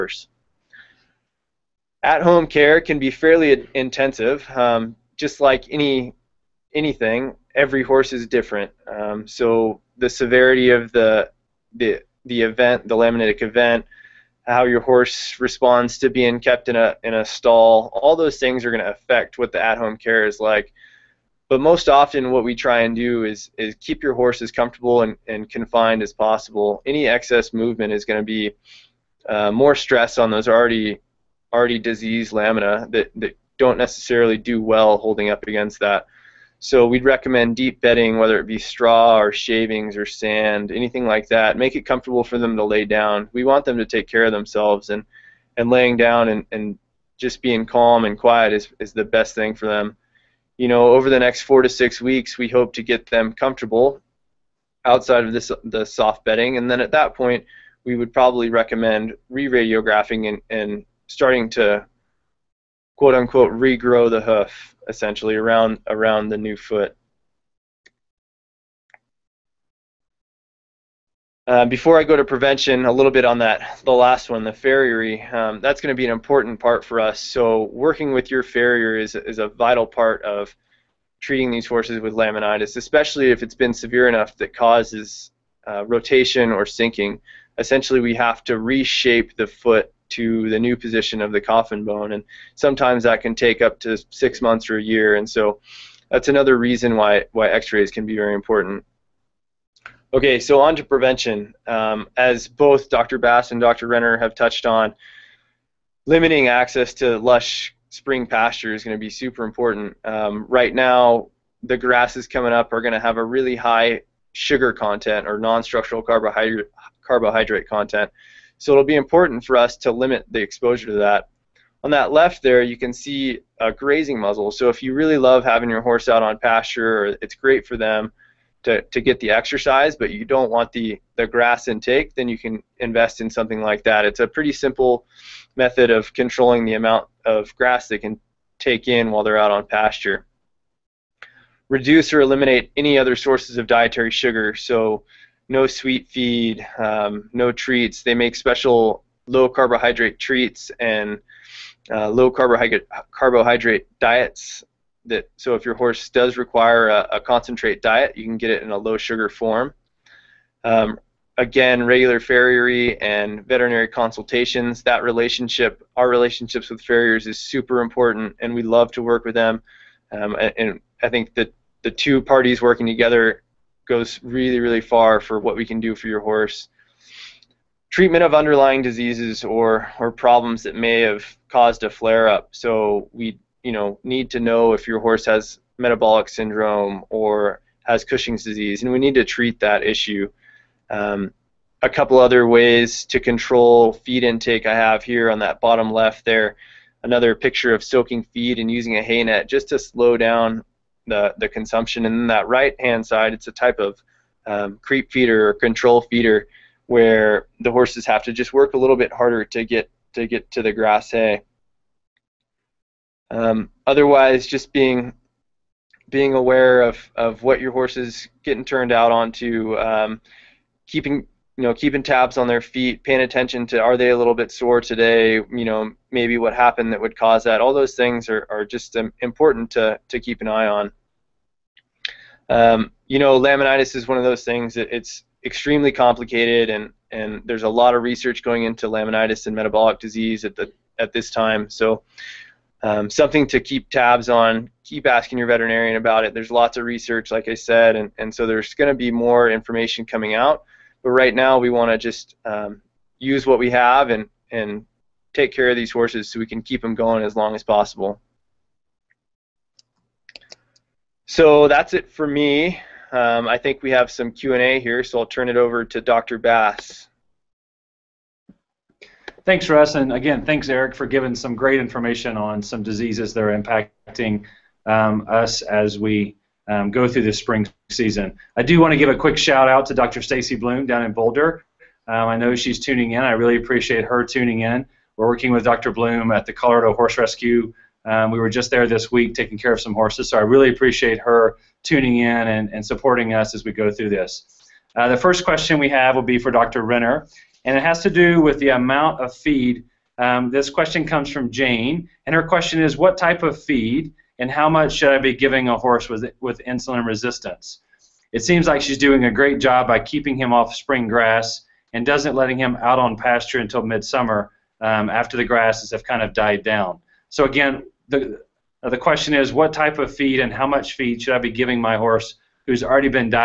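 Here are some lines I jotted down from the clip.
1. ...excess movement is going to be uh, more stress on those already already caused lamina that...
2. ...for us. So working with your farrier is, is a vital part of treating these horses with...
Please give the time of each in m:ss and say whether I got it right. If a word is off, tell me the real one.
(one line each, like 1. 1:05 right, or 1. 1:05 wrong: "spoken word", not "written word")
1. 0:27 wrong: "diseased", not "caused"
2. 1:16 right.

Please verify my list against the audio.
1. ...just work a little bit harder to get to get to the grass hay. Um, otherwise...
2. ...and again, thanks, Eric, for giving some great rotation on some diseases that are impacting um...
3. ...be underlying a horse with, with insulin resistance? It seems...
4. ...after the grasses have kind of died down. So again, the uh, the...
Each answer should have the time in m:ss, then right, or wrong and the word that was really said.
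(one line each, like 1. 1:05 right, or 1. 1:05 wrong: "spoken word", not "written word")
1. 3:28 right
2. 4:29 wrong: "information", not "rotation"
3. 5:05 wrong: "giving", not "underlying"
4. 5:15 right.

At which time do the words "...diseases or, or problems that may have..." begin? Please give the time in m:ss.
2:58.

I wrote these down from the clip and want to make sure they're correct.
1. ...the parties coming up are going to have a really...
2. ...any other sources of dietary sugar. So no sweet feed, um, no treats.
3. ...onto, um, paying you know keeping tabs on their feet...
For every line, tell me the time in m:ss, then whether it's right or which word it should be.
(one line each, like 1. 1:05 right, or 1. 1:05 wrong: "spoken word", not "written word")
1. 1:51 wrong: "grasses", not "parties"
2. 2:22 right
3. 3:39 wrong: "keeping", not "paying".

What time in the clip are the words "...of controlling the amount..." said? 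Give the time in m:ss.
2:15.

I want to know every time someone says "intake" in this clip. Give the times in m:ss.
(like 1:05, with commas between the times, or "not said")
2:11, 3:14.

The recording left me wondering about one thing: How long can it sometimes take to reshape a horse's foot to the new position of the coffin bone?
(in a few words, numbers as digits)
6 months or a year.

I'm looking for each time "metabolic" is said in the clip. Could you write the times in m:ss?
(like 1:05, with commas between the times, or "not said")
3:05, 3:59.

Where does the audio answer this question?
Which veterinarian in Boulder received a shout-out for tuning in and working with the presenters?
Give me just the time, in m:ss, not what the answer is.
4:39.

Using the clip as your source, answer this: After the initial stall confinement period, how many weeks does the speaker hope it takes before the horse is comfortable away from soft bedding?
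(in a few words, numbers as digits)
4 to 6 weeks.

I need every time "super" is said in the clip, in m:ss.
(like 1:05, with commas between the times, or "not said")
1:49, 2:47.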